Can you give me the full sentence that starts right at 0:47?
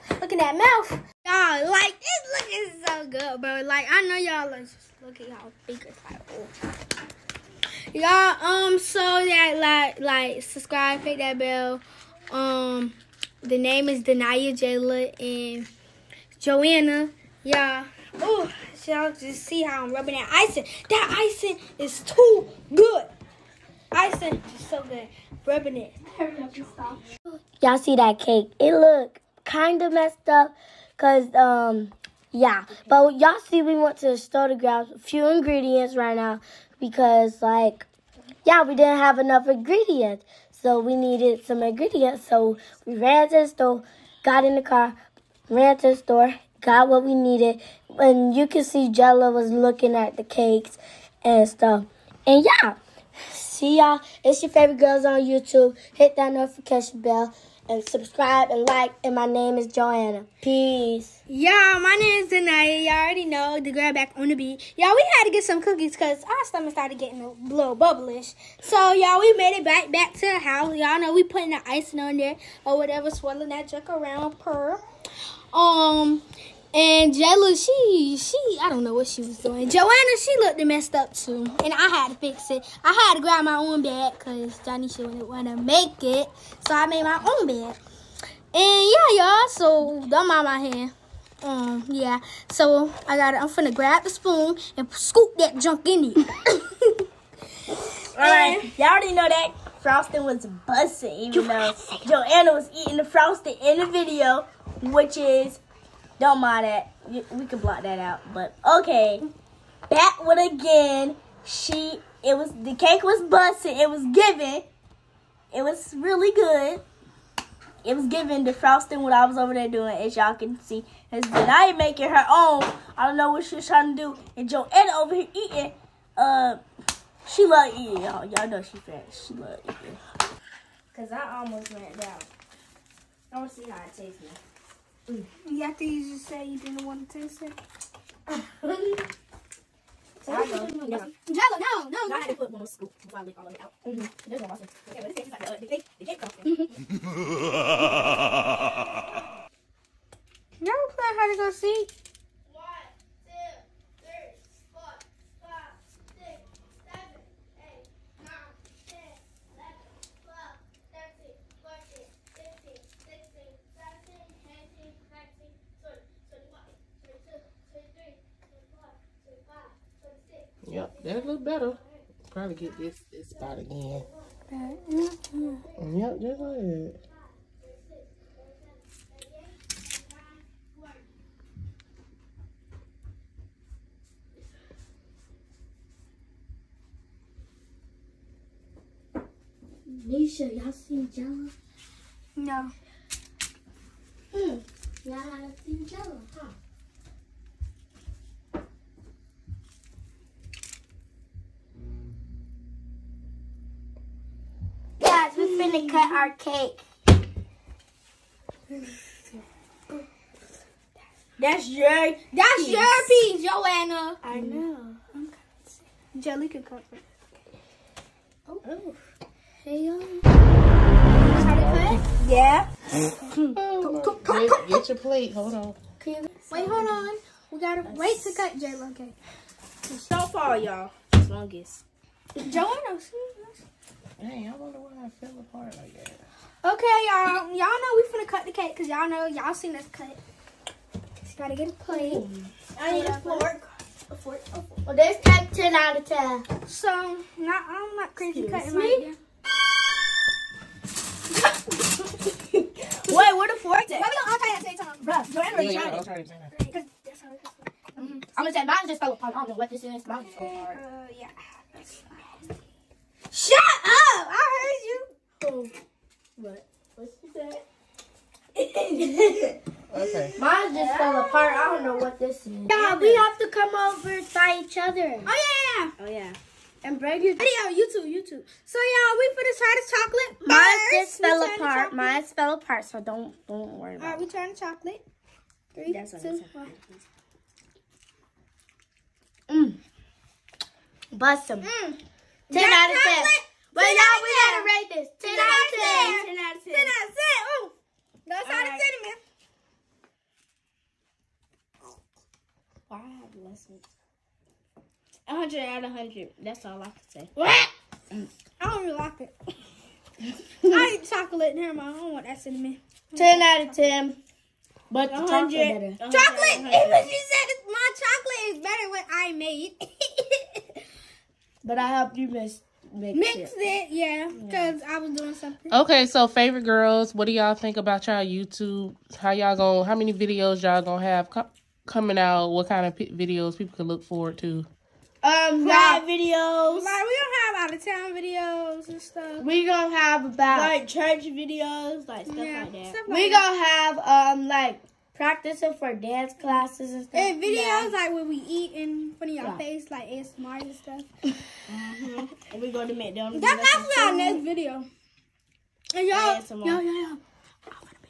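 And you can see Jella was looking at the cakes and stuff.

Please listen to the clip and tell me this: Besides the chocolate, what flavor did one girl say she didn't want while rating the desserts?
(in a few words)
Cinnamon.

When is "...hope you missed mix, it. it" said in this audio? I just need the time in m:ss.
5:22.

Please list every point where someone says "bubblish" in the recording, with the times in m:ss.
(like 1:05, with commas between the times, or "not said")
1:07.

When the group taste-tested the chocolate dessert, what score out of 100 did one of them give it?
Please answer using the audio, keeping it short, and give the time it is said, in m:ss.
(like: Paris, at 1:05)
100 out of 100, at 5:05.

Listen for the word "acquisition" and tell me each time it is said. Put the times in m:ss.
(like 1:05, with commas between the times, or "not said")
not said.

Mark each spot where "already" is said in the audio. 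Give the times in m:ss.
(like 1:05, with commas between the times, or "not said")
1:02, 1:38.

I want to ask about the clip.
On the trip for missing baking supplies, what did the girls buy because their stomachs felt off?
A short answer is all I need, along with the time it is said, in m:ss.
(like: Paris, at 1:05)
Cookies, at 1:05.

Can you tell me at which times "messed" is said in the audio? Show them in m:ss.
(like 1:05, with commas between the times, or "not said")
0:29, 1:20.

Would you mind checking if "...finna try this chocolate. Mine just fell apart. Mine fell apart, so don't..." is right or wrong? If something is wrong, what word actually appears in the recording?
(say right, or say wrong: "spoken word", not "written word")
right.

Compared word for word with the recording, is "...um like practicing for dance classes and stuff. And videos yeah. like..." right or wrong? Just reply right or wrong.
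right.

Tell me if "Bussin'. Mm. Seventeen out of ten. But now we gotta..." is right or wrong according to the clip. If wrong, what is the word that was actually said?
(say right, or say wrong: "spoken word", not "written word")
wrong: "Ten", not "Seventeen".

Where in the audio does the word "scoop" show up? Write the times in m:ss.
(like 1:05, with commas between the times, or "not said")
1:34, 2:22.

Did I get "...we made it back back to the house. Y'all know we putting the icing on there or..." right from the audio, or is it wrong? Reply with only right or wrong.
right.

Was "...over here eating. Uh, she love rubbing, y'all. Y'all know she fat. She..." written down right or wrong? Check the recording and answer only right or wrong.
wrong.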